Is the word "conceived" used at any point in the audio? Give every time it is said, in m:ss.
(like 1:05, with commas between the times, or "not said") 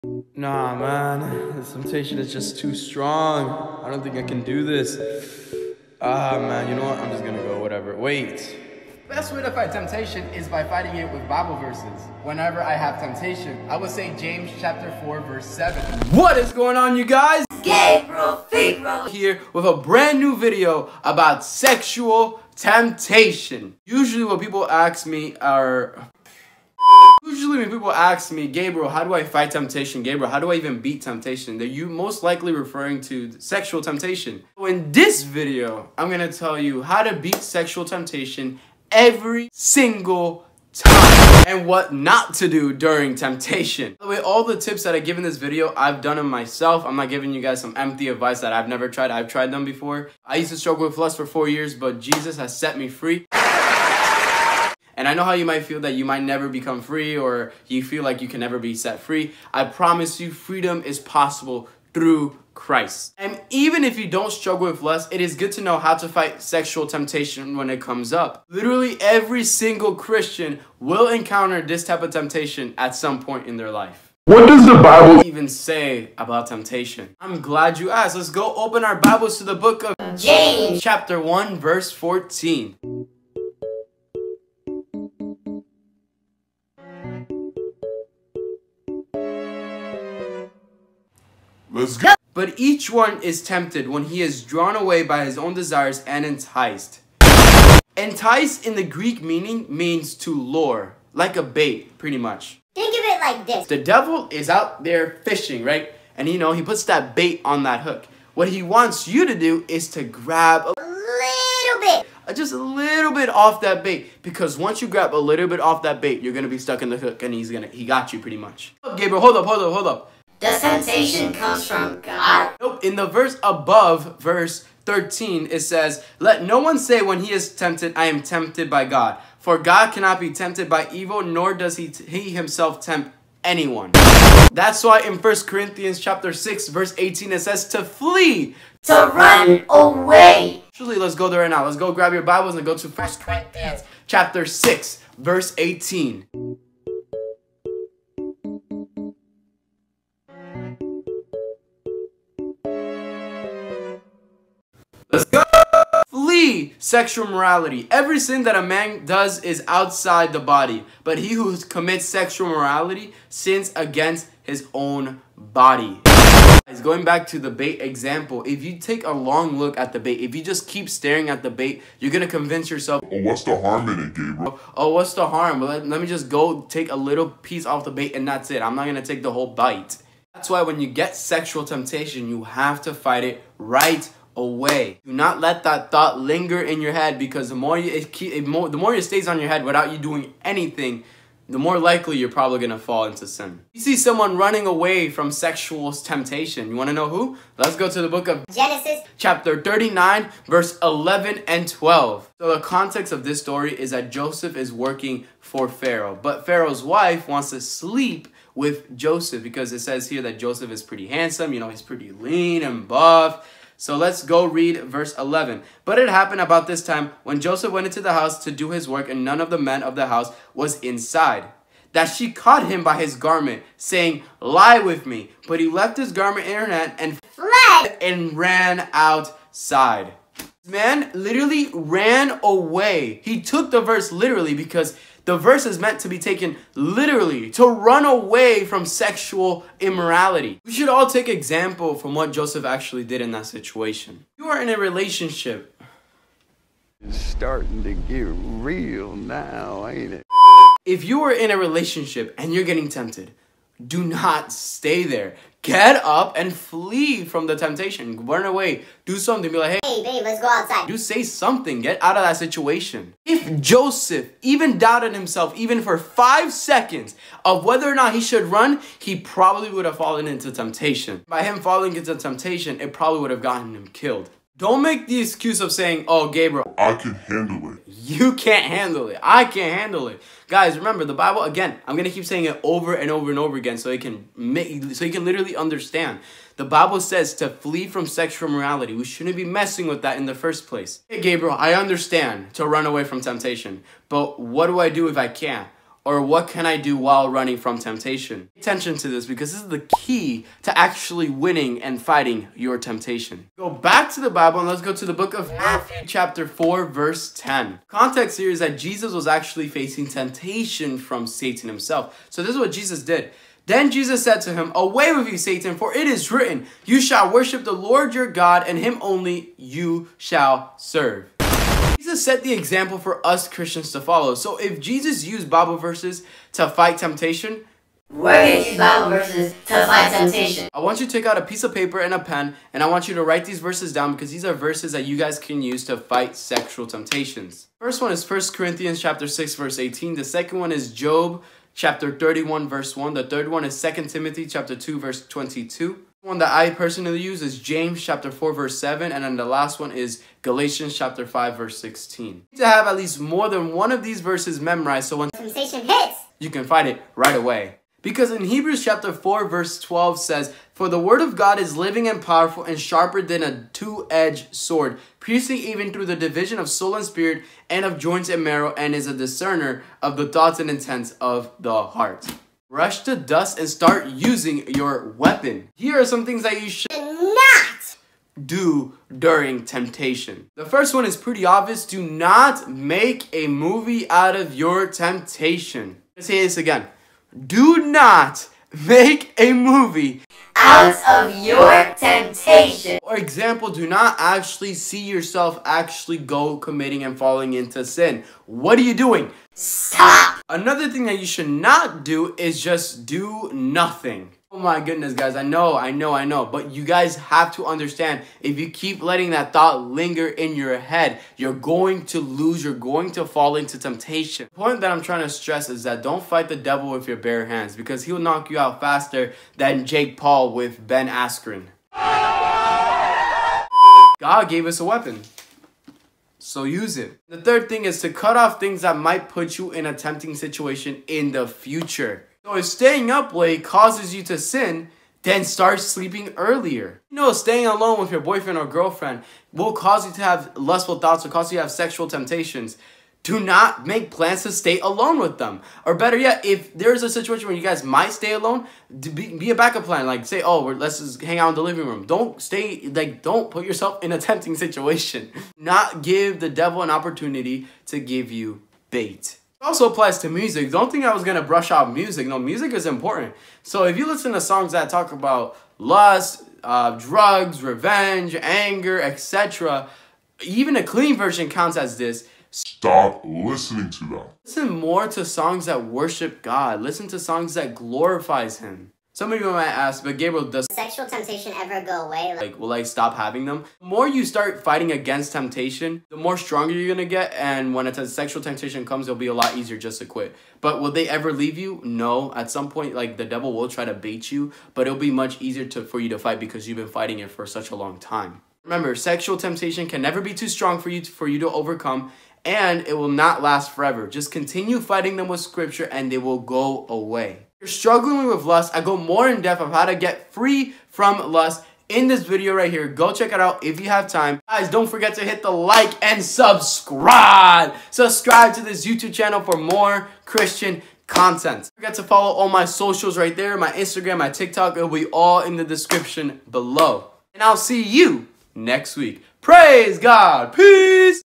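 not said.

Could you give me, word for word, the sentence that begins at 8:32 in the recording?
Go check it out if you have time.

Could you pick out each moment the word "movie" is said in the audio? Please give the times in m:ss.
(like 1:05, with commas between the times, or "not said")
6:23, 6:29.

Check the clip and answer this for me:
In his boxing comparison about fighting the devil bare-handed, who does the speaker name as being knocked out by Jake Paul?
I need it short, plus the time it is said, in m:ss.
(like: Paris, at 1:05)
Ben Askren, at 7:00.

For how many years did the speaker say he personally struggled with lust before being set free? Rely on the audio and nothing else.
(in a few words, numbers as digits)
4.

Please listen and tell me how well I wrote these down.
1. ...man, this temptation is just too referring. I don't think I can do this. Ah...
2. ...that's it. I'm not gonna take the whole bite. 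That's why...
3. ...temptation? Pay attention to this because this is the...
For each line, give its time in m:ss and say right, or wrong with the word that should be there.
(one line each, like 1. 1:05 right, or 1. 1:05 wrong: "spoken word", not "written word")
1. 0:00 wrong: "strong", not "referring"
2. 2:58 right
3. 4:57 right.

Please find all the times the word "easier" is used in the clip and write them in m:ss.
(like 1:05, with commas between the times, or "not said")
8:09, 8:15.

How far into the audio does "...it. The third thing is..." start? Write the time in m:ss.
7:06.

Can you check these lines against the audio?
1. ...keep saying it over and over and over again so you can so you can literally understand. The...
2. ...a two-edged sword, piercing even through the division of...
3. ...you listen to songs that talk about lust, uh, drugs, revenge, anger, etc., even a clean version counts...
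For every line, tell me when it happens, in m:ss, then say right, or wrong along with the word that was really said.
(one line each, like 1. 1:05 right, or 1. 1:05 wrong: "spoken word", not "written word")
1. 4:42 right
2. 6:03 right
3. 7:43 right.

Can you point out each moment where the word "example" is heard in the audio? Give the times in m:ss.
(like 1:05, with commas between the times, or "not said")
2:47, 4:01, 5:22, 6:33.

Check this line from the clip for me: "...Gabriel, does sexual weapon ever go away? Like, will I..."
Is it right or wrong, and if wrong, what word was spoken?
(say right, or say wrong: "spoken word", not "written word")
wrong: "temptation", not "weapon".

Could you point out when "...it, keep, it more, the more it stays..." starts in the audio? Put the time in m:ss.
3:07.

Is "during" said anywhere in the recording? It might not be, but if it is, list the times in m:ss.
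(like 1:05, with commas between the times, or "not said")
0:42, 6:19.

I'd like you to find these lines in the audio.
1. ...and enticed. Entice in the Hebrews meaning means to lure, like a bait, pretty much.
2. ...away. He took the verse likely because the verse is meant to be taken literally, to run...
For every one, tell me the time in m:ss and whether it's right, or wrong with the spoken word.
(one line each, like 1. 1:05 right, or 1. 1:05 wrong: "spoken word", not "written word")
1. 1:36 wrong: "Greek", not "Hebrews"
2. 3:52 wrong: "literally", not "likely".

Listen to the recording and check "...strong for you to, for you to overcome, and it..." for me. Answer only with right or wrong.
right.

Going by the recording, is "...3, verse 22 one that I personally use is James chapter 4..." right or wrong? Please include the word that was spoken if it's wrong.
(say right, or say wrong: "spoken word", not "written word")
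wrong: "2", not "3".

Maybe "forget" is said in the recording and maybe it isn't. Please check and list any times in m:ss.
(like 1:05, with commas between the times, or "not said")
8:34, 8:41.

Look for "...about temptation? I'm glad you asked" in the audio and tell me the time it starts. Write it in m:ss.
1:16.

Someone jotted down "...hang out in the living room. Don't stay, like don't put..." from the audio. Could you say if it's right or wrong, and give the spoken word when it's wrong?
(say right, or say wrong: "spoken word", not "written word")
right.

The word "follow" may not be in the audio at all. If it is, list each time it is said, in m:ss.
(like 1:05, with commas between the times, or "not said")
5:24, 8:42.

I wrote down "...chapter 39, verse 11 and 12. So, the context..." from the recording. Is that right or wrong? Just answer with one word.
right.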